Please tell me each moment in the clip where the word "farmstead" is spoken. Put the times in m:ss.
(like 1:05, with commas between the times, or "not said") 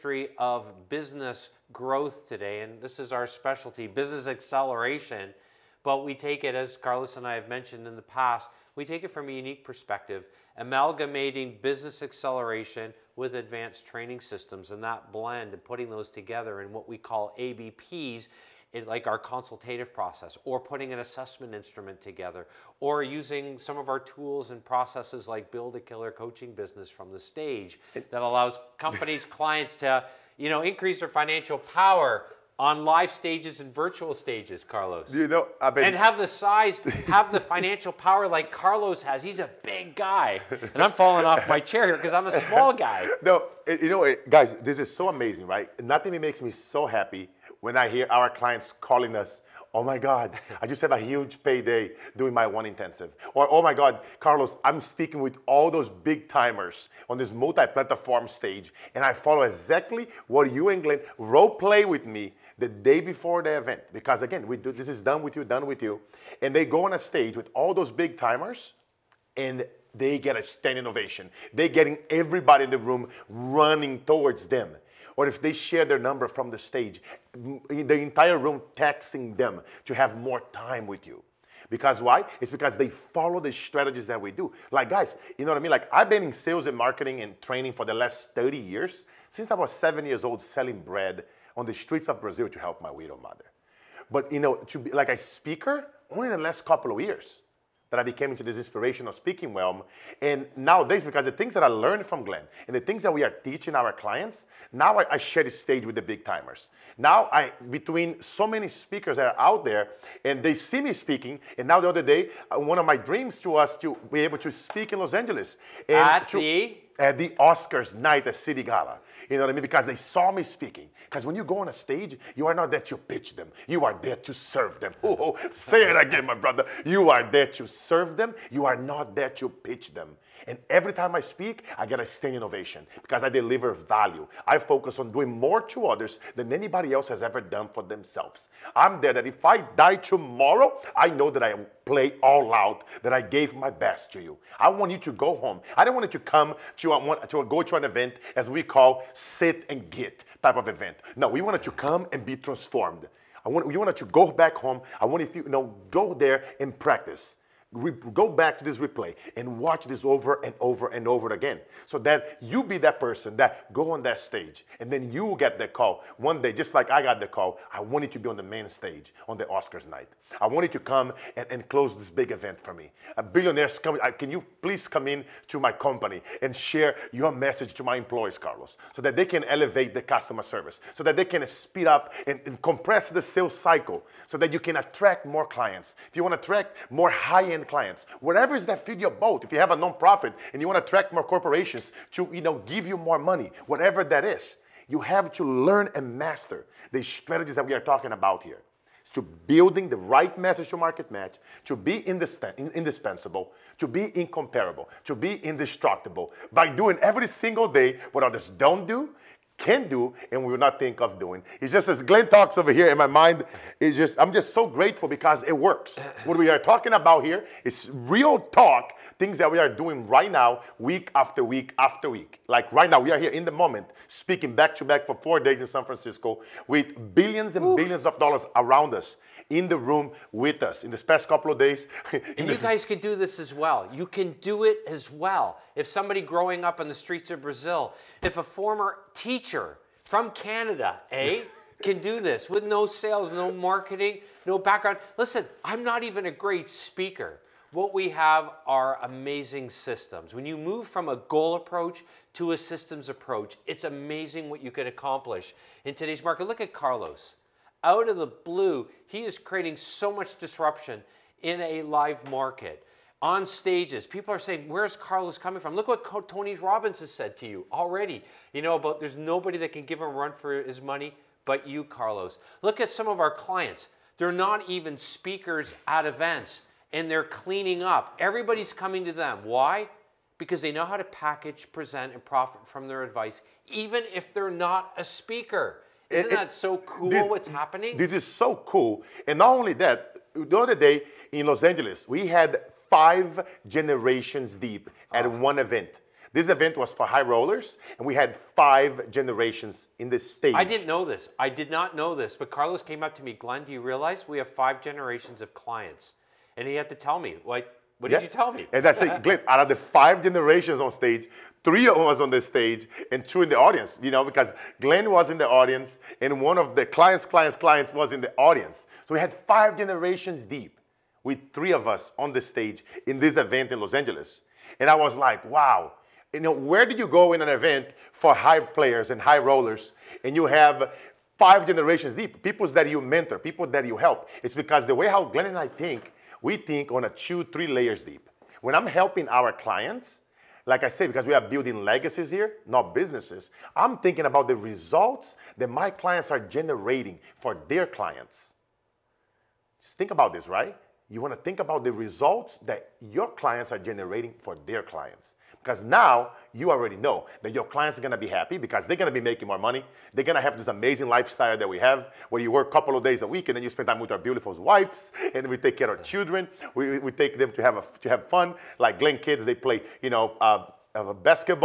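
not said.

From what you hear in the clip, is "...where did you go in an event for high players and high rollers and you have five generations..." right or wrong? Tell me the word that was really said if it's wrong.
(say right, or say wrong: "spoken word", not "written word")
right.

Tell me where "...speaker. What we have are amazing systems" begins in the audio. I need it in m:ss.
4:06.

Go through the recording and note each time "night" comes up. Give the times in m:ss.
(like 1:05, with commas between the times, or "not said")
1:57, 2:49.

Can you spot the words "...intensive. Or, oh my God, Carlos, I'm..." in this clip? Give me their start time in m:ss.
0:52.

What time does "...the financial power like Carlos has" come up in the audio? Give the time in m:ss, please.
0:37.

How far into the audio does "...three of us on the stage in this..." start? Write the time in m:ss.
5:21.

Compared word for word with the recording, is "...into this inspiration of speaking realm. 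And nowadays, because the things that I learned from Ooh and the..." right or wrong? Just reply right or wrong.
wrong.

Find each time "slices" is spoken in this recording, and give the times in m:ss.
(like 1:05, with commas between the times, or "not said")
not said.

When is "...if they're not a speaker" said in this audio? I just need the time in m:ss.
4:44.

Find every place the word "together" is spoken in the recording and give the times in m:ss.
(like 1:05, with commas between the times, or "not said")
0:16, 0:21.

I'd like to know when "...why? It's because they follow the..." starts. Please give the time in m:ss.
1:22.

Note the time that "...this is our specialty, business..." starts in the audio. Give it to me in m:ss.
0:02.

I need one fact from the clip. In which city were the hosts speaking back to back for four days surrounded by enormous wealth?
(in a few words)
San Francisco.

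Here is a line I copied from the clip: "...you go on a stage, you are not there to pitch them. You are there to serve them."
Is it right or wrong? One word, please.
right.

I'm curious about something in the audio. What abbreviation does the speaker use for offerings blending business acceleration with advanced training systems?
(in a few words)
ABPs.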